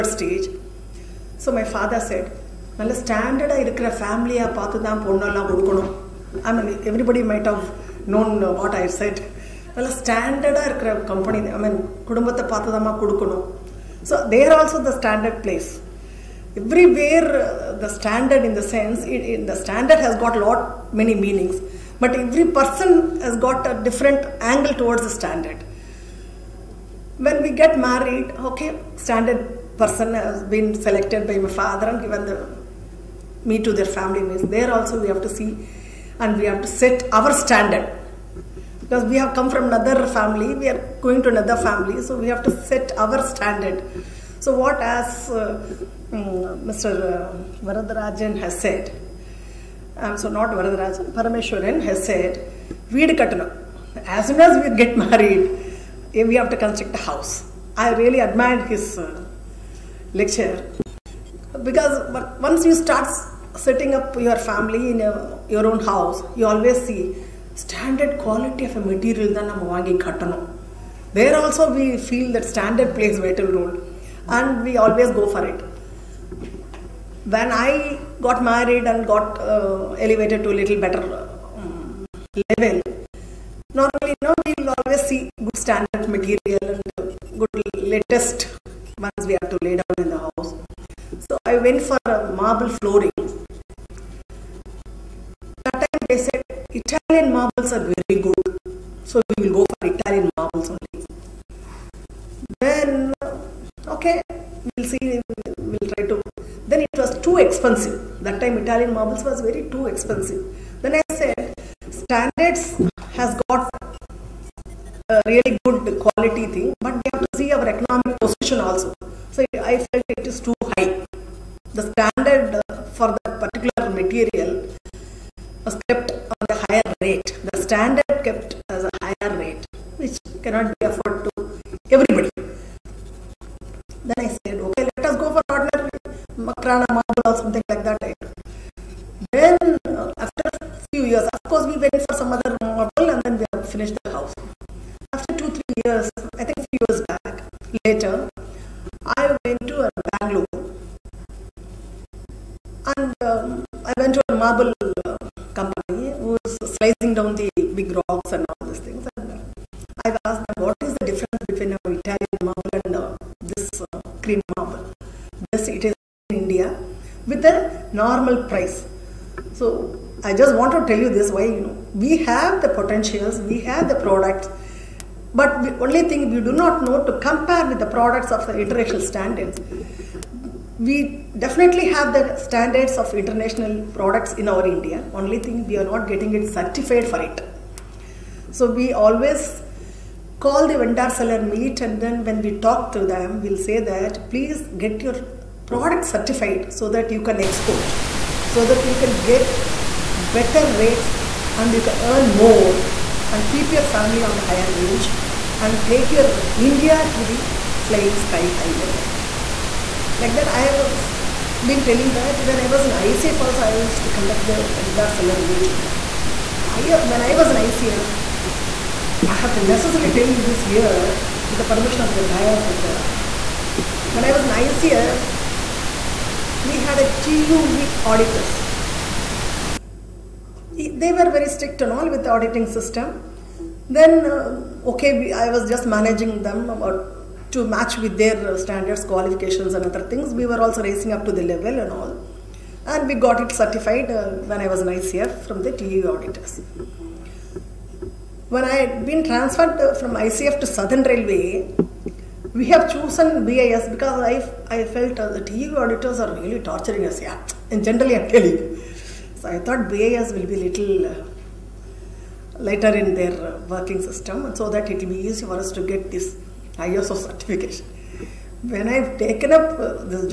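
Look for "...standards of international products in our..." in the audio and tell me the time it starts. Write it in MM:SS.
03:02.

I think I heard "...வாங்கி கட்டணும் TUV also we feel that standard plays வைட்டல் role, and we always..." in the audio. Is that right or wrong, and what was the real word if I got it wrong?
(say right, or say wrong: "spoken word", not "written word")
wrong: "There", not "TUV".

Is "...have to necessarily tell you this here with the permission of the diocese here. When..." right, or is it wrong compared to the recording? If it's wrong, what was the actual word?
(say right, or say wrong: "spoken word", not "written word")
right.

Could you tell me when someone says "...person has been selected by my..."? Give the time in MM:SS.
00:29.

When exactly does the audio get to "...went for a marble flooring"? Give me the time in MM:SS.
01:31.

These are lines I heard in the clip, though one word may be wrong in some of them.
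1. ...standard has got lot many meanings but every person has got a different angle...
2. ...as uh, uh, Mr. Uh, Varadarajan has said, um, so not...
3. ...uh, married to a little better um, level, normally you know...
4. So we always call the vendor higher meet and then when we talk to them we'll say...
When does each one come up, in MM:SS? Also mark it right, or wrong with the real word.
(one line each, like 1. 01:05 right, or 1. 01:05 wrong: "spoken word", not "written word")
1. 00:19 right
2. 00:44 right
3. 01:19 wrong: "elevated", not "married"
4. 03:08 wrong: "seller", not "higher".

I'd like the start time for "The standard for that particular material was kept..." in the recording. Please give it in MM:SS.
02:01.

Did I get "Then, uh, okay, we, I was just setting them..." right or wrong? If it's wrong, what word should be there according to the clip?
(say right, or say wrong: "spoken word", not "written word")
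wrong: "managing", not "setting".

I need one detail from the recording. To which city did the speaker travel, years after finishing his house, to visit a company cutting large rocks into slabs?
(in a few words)
Bangalore.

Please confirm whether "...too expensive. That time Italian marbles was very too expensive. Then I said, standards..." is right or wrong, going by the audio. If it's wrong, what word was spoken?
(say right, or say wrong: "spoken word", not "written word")
right.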